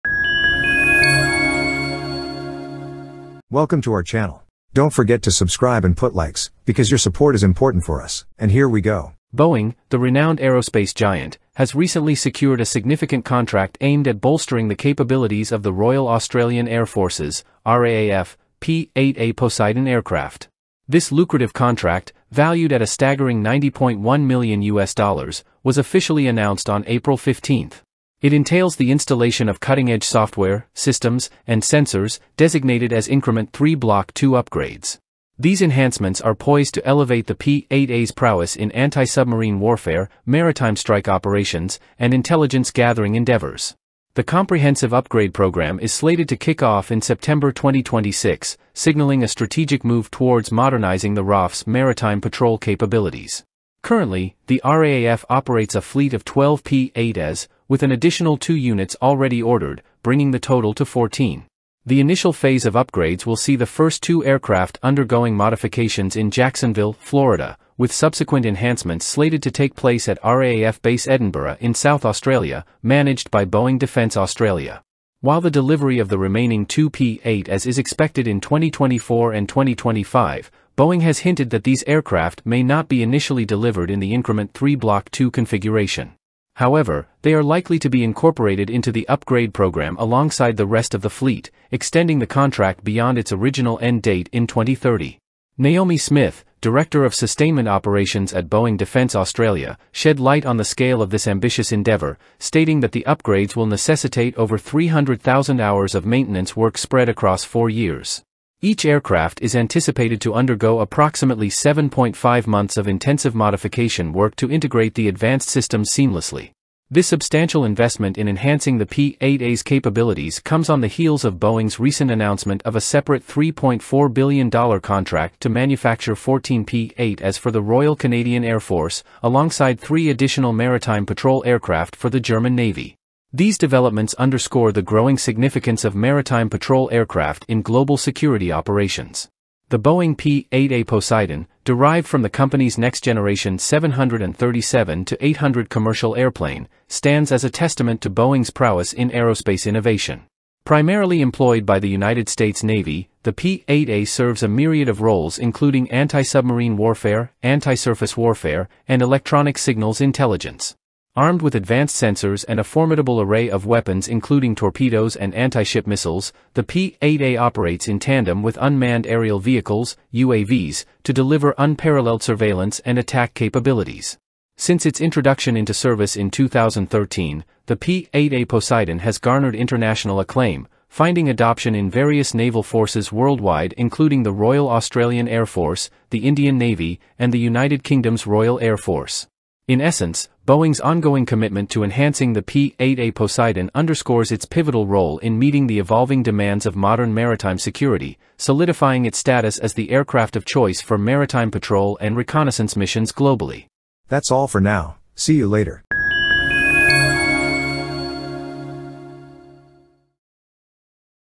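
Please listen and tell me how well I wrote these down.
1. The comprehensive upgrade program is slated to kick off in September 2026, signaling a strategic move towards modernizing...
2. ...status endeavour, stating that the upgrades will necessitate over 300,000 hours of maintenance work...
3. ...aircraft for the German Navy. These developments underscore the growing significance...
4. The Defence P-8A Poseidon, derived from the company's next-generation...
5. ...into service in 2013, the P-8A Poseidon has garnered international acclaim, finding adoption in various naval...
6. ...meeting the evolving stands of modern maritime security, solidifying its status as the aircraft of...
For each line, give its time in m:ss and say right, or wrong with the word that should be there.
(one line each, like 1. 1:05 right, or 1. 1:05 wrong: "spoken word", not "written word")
1. 0:44 right
2. 1:41 wrong: "ambitious", not "status"
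3. 2:11 right
4. 2:19 wrong: "Boeing", not "Defence"
5. 2:55 right
6. 3:15 wrong: "demands", not "stands".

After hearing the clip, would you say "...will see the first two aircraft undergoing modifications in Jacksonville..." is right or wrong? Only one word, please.
right.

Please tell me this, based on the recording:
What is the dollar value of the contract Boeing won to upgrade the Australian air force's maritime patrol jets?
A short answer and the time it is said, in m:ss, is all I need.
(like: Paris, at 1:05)
$90.1 million, at 0:23.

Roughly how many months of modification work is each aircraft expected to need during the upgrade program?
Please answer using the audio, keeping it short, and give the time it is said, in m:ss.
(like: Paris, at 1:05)
7.5 months, at 1:51.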